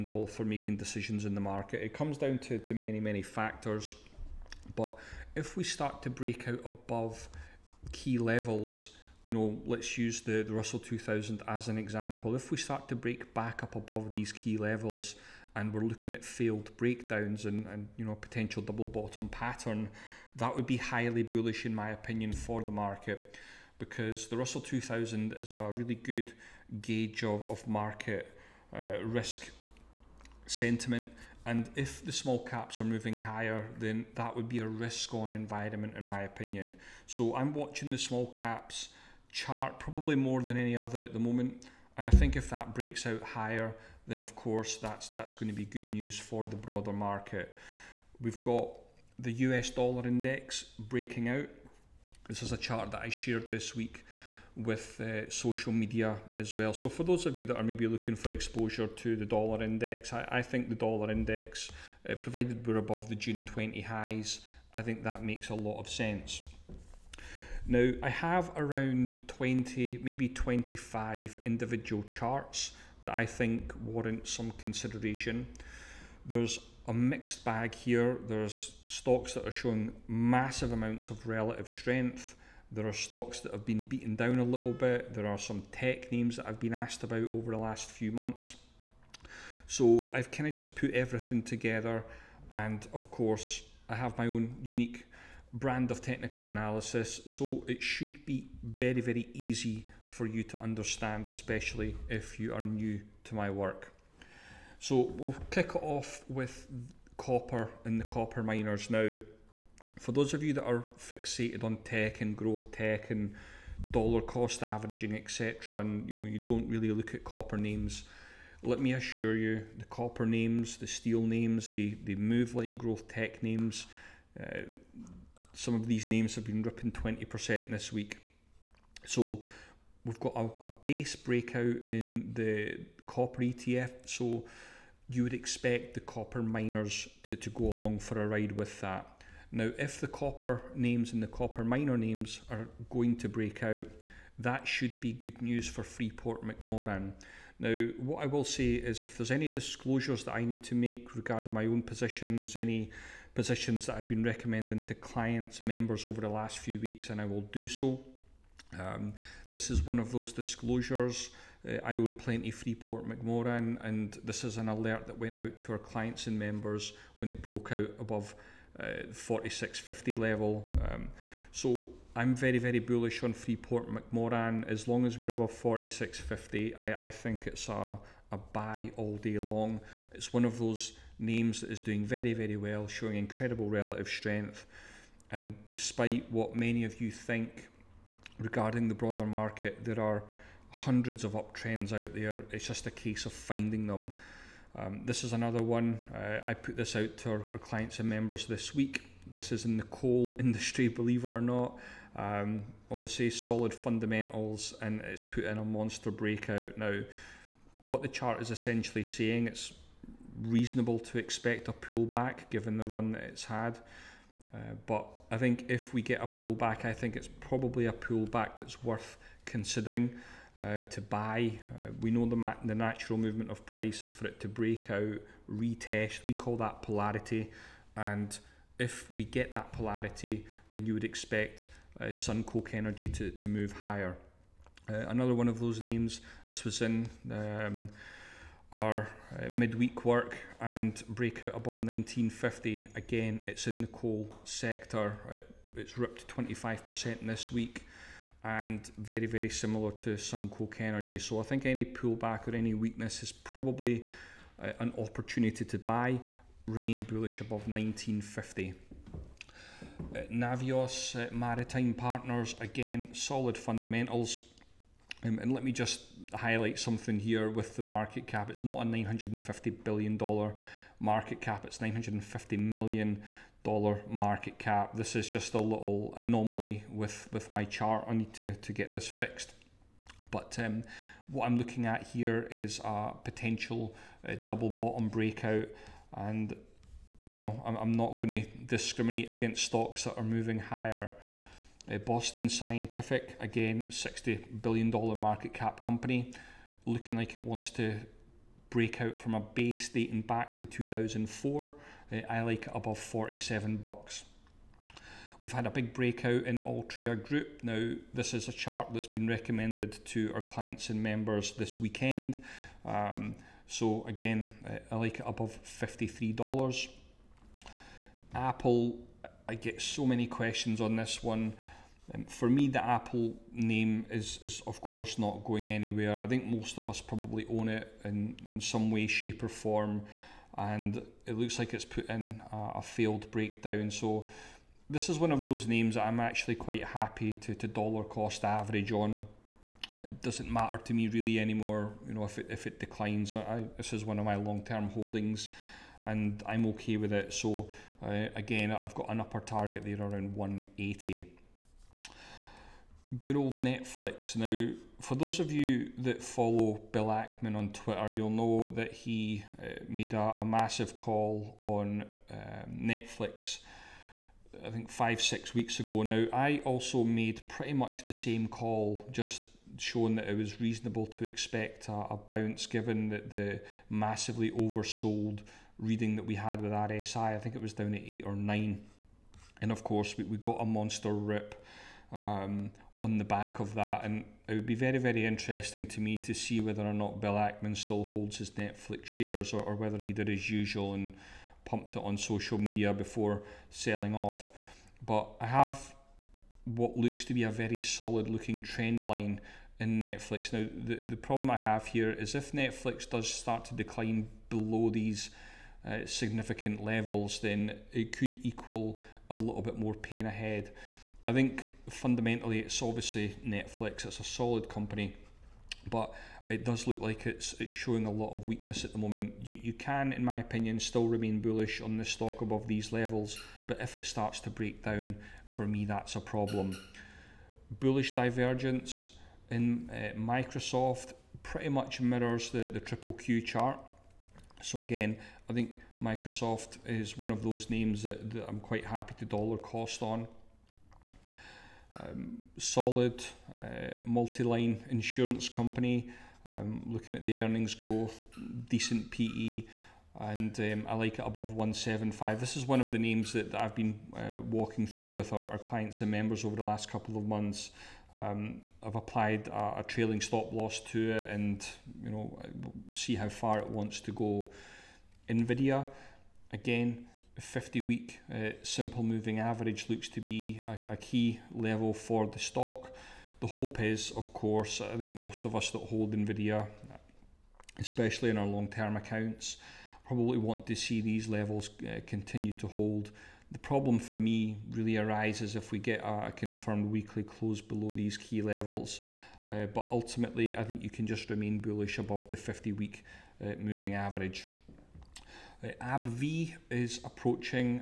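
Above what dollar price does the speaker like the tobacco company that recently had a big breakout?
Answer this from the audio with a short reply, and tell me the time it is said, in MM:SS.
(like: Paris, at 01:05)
$53, at 05:15.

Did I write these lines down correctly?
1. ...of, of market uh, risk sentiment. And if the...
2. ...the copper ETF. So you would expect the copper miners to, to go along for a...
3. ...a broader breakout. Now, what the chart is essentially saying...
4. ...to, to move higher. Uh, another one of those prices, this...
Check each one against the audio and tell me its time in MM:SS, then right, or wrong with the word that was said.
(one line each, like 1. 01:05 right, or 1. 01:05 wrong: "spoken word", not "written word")
1. 00:27 right
2. 02:12 right
3. 03:25 wrong: "monster", not "broader"
4. 03:53 wrong: "names", not "prices".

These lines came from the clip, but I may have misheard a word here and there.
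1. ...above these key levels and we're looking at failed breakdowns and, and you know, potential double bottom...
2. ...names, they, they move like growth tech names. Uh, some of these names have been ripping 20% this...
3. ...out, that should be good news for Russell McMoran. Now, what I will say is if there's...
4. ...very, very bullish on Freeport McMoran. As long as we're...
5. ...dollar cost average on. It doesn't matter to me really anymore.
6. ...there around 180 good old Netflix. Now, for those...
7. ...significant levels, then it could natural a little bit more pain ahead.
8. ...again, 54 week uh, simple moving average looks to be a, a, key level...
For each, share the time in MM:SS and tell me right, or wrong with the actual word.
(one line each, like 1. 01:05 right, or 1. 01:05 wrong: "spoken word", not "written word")
1. 00:13 right
2. 02:01 right
3. 02:23 wrong: "Freeport", not "Russell"
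4. 02:52 right
5. 05:37 right
6. 05:49 right
7. 06:46 wrong: "equal", not "natural"
8. 07:46 wrong: "50", not "54".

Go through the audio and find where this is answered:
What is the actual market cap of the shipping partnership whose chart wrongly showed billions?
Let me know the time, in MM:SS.
04:31.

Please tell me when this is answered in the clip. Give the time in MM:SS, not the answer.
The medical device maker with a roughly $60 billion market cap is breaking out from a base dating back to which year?
05:00.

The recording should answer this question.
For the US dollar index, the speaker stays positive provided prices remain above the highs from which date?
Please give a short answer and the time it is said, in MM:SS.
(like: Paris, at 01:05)
June 20, at 01:03.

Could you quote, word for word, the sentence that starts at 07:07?
Bullish divergence in uh, Microsoft pretty much mirrors the the triple Q chart.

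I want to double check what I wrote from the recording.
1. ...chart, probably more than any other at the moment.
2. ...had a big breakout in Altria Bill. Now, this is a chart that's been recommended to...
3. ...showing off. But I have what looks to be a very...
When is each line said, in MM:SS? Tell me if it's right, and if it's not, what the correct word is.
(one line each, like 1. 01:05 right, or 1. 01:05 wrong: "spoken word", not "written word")
1. 00:39 right
2. 05:05 wrong: "Group", not "Bill"
3. 06:33 wrong: "selling", not "showing".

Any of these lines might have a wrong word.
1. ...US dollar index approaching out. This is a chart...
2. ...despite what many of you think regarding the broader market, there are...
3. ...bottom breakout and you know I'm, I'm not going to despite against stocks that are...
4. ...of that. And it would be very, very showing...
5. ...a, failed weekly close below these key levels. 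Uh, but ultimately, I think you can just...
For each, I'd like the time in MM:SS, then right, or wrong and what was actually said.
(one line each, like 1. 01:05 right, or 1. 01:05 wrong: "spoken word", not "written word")
1. 00:49 wrong: "breaking", not "approaching"
2. 03:05 right
3. 04:44 wrong: "discriminate", not "despite"
4. 06:23 wrong: "interesting", not "showing"
5. 08:06 wrong: "confirmed", not "failed".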